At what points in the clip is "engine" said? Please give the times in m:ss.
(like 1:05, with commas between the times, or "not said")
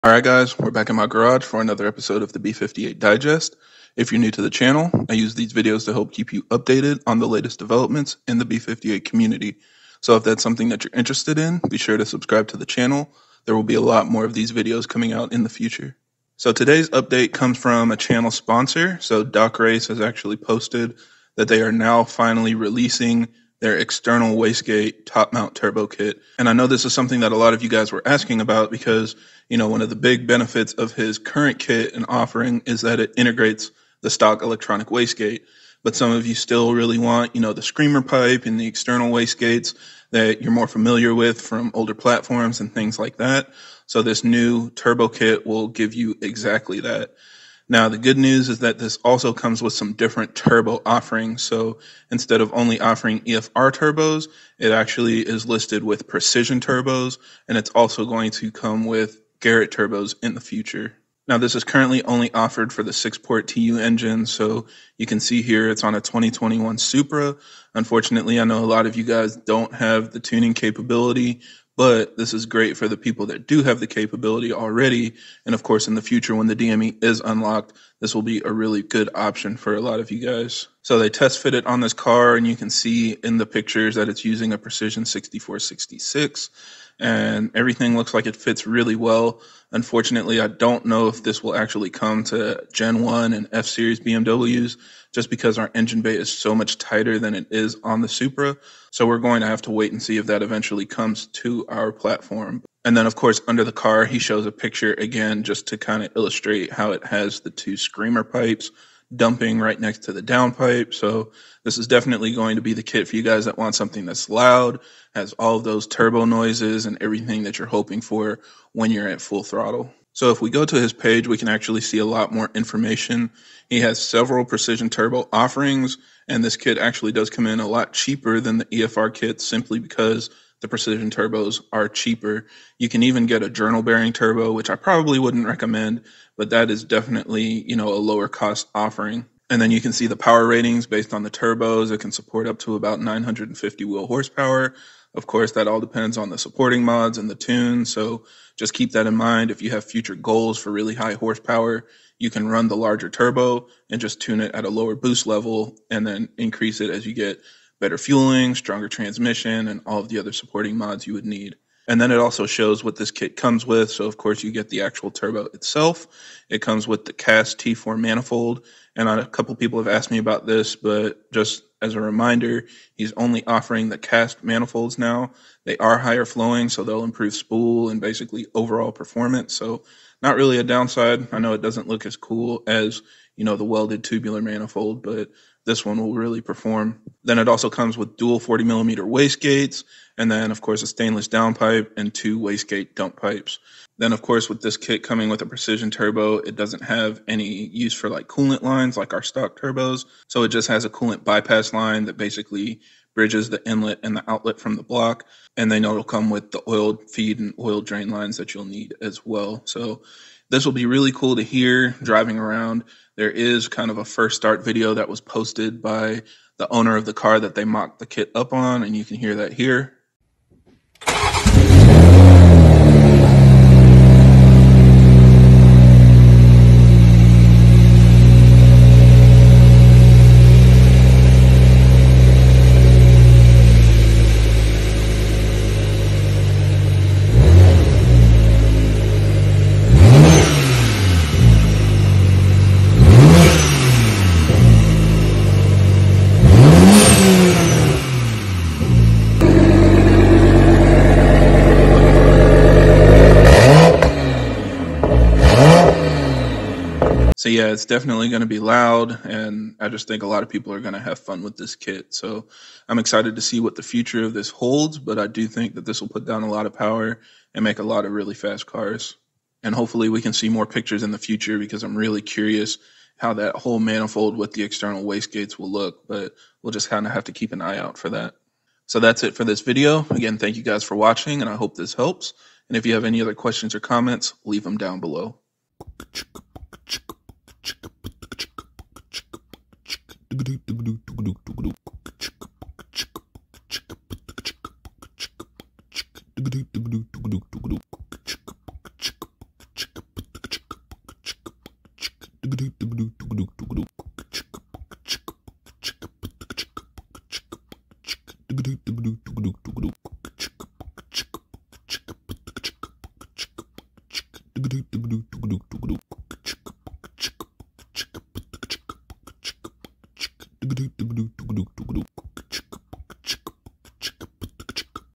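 1:03, 1:35.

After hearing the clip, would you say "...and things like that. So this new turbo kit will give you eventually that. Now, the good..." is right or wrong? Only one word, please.
wrong.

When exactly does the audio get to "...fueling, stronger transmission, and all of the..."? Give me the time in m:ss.
2:37.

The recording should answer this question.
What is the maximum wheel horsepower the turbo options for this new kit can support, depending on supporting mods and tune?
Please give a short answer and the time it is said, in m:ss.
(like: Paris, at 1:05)
950, at 2:23.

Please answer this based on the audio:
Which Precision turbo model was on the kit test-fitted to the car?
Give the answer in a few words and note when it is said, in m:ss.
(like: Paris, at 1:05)
Precision 6466, at 1:24.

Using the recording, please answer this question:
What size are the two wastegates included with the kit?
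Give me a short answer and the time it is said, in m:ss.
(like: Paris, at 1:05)
40 millimeter, at 3:08.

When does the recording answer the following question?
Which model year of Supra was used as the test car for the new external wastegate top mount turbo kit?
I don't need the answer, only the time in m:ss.
1:06.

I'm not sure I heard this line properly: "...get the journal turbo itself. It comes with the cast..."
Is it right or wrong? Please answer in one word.
wrong.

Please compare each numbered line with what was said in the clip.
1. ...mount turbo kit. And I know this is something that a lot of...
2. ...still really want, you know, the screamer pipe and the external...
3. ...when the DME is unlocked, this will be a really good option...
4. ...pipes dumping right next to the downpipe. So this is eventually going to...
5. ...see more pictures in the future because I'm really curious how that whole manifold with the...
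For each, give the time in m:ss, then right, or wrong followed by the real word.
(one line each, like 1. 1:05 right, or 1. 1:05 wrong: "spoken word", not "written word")
1. 0:25 right
2. 0:36 right
3. 1:16 right
4. 1:48 wrong: "definitely", not "eventually"
5. 4:30 right.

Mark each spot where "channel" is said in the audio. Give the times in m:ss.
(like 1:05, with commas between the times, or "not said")
0:04, 0:12, 0:17.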